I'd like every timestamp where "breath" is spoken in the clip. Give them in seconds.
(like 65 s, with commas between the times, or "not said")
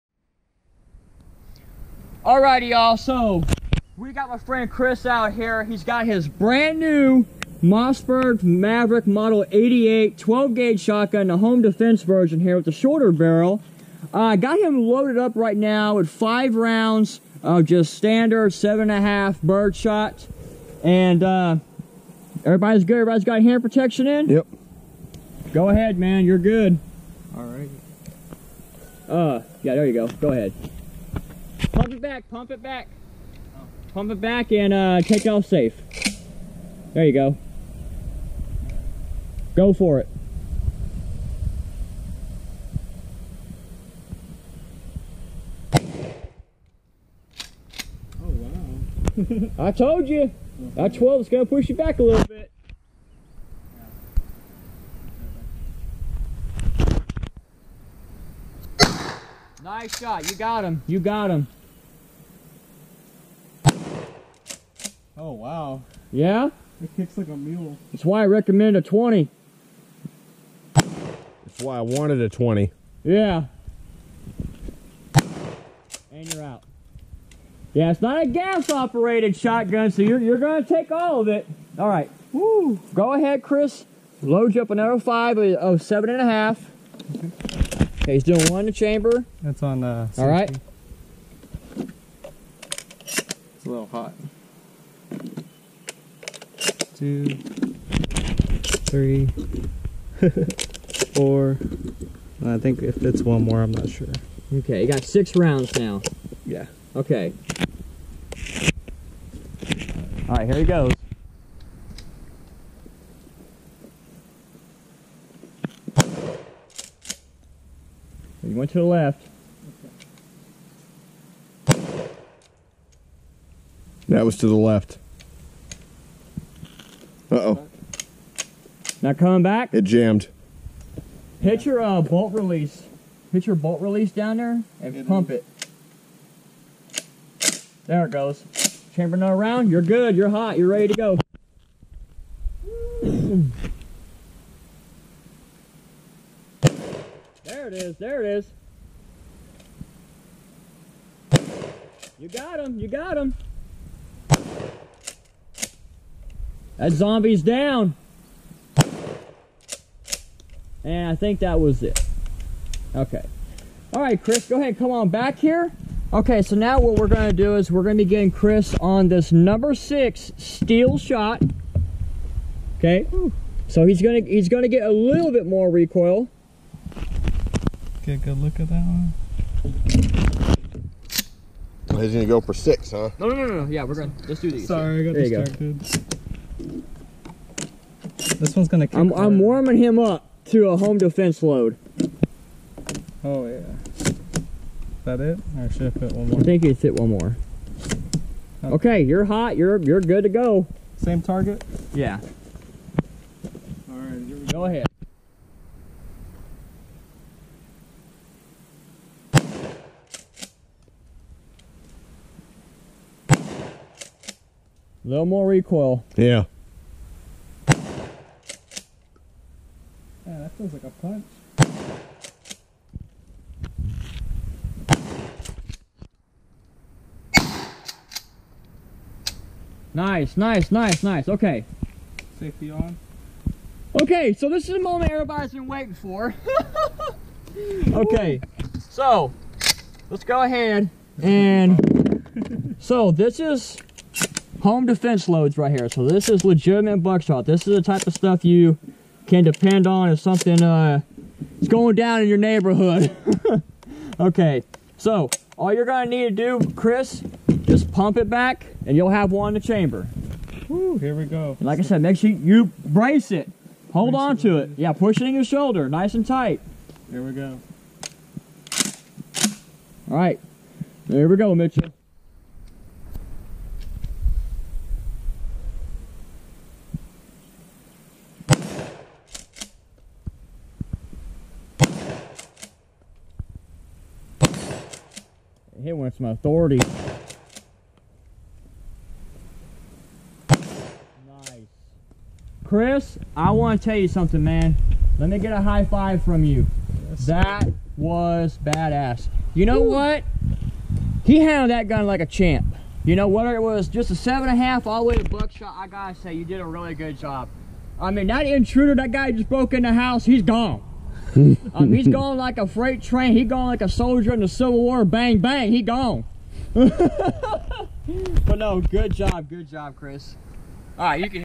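not said.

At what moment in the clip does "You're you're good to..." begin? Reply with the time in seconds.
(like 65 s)
199 s.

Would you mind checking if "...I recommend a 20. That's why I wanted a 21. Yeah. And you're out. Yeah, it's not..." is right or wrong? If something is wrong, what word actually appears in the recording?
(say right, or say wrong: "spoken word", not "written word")
wrong: "20", not "21".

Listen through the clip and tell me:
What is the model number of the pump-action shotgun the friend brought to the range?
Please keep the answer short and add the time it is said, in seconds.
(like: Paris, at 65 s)
88, at 9 s.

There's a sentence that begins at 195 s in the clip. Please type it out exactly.
Or should put fit one more?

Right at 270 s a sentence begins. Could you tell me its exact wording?
All right, there we go, Mitchell.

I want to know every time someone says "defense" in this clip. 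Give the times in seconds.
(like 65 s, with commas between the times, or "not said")
11 s, 190 s, 244 s.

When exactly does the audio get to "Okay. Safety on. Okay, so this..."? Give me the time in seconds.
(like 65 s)
231 s.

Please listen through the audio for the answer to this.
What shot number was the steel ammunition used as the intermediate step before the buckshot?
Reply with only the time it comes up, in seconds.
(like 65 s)
169 s.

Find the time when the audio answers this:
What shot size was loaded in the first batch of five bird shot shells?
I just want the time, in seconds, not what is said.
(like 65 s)
18 s.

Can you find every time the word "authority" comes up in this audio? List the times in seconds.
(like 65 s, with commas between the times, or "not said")
286 s.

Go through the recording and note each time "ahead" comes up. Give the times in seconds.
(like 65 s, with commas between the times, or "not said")
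25 s, 30 s, 83 s, 164 s, 204 s, 240 s.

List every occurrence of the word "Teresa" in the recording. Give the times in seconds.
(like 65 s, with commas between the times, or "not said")
not said.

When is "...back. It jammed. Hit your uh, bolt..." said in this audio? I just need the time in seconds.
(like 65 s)
129 s.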